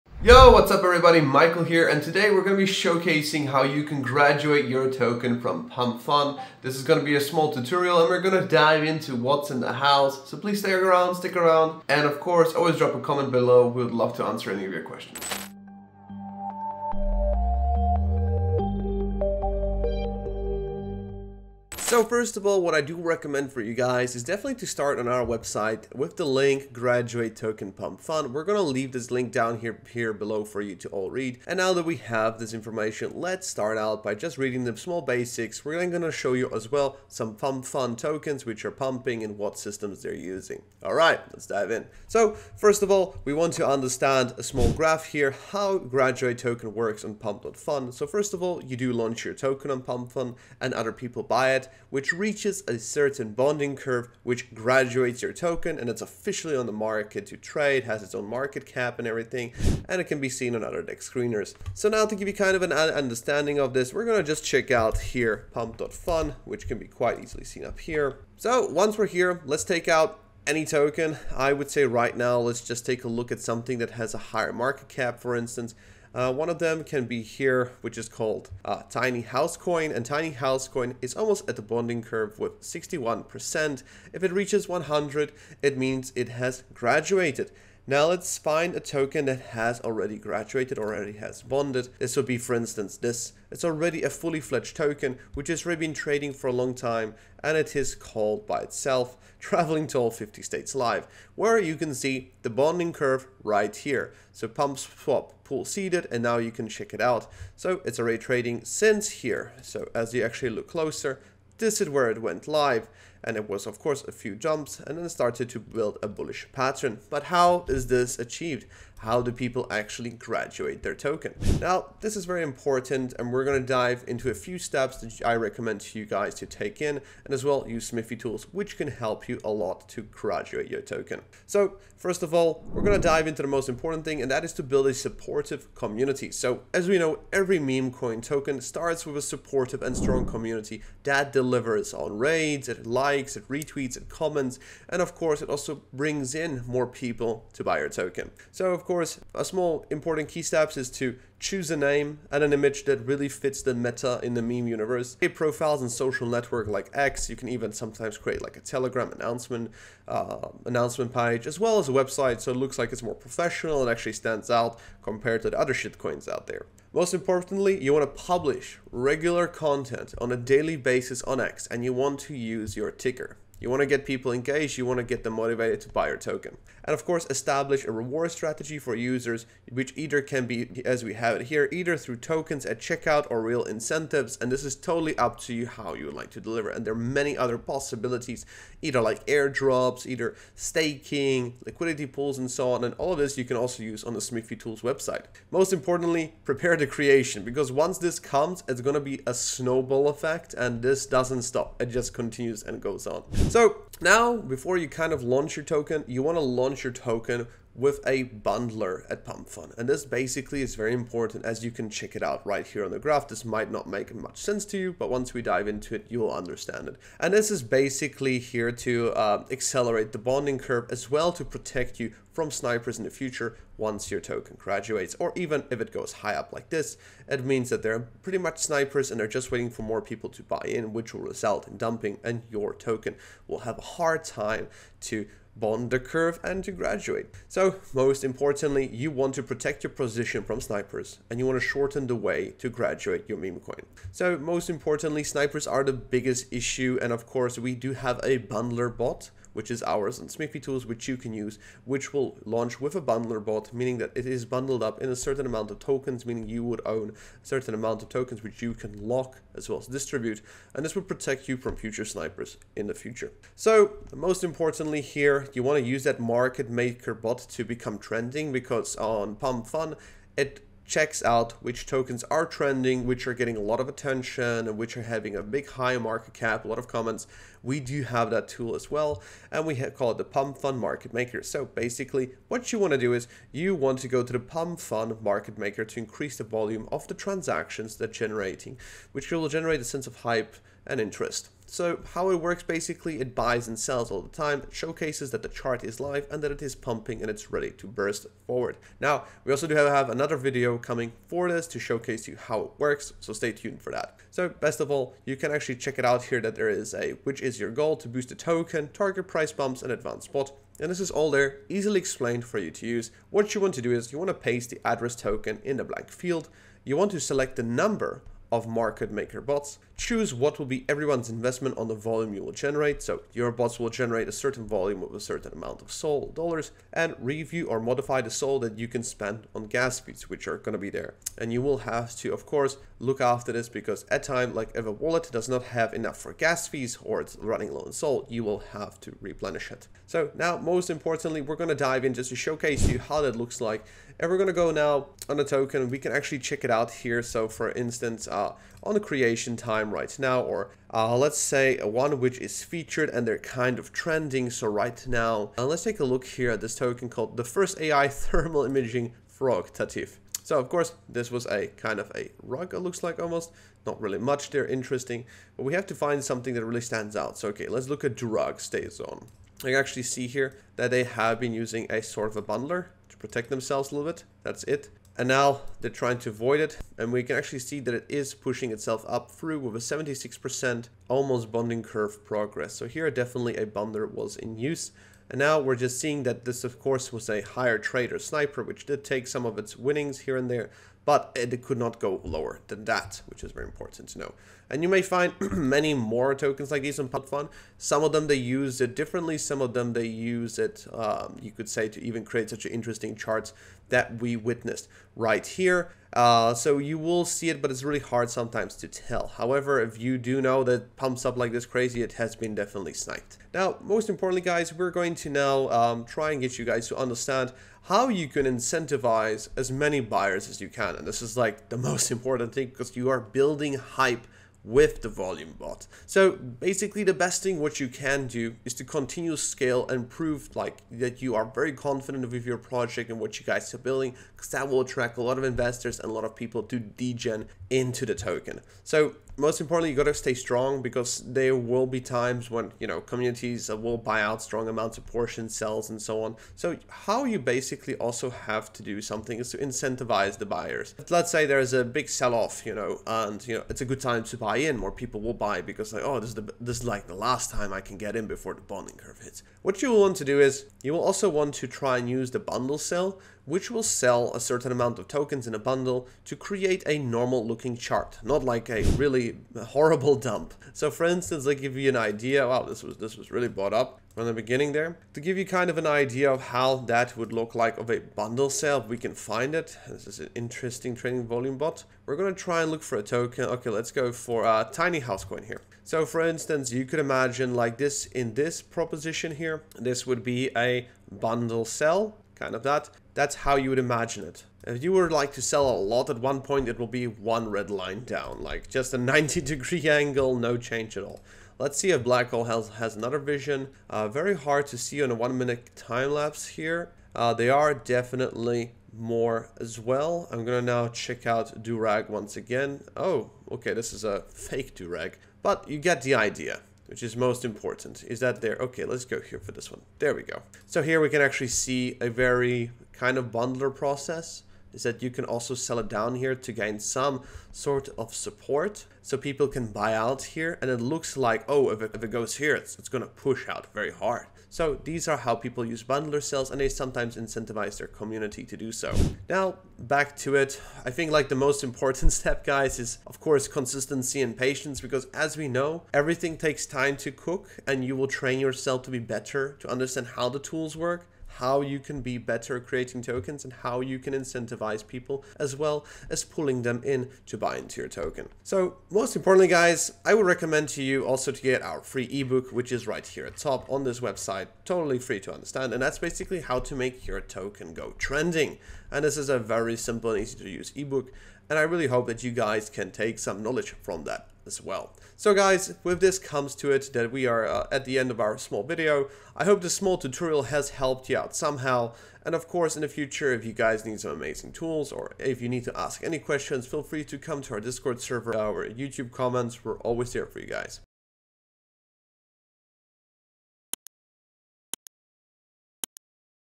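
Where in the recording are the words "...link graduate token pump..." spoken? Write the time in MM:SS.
00:26.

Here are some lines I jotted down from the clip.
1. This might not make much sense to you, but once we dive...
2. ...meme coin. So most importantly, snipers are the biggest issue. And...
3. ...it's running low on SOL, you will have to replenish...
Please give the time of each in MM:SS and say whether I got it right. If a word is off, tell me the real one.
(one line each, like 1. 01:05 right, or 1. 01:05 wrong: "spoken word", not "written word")
1. 03:33 right
2. 04:03 right
3. 05:37 right.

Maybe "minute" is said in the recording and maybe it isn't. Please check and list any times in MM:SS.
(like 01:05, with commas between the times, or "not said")
08:25.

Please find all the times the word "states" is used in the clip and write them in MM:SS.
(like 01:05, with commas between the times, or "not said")
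01:40.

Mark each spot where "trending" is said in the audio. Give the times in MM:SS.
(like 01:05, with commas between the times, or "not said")
04:27, 04:32, 05:53, 09:27.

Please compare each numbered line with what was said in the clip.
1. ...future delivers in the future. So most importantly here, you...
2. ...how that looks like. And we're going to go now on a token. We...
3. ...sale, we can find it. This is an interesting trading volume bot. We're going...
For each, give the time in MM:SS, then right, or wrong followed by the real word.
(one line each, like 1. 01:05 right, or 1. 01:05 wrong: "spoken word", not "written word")
1. 04:21 wrong: "snipers", not "delivers"
2. 05:42 right
3. 07:58 right.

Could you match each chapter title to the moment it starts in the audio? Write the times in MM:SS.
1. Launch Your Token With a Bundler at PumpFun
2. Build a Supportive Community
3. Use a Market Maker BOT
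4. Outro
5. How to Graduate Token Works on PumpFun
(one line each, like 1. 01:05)
1. 03:33
2. 02:15
3. 04:24
4. 09:34
5. 00:42.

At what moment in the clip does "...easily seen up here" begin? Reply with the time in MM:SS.
01:07.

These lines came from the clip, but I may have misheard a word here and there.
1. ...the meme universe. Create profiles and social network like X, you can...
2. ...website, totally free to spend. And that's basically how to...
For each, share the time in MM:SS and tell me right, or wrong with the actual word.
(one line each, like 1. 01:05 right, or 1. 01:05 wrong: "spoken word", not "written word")
1. 02:34 right
2. 09:24 wrong: "understand", not "spend".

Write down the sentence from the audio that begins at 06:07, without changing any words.
So okay, let's look at Drug Stay Zone.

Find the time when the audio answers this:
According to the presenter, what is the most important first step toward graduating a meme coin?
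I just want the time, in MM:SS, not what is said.
02:14.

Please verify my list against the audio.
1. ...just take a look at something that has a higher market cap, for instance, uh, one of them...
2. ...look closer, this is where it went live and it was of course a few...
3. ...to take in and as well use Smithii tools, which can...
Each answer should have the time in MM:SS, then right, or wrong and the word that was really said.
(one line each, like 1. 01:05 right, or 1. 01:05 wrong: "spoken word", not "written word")
1. 01:12 right
2. 01:50 right
3. 02:06 right.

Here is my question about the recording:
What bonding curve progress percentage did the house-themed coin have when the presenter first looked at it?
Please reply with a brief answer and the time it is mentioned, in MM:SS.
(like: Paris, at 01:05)
61%, at 01:22.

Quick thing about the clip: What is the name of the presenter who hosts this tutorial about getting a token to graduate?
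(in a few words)
Michael.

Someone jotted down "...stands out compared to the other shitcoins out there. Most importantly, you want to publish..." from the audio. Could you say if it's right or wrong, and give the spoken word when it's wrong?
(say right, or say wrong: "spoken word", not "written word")
right.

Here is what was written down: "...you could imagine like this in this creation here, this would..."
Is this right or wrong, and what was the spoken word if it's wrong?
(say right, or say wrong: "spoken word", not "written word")
wrong: "proposition", not "creation".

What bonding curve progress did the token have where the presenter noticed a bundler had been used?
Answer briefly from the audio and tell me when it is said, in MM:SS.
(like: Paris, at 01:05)
76%, at 06:19.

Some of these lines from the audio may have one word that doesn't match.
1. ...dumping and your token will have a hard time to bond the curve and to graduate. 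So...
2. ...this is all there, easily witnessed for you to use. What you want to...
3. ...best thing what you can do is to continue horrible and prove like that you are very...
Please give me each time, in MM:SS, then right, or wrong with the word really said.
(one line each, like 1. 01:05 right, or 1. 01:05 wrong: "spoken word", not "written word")
1. 03:51 right
2. 05:10 wrong: "explained", not "witnessed"
3. 07:07 wrong: "scale", not "horrible".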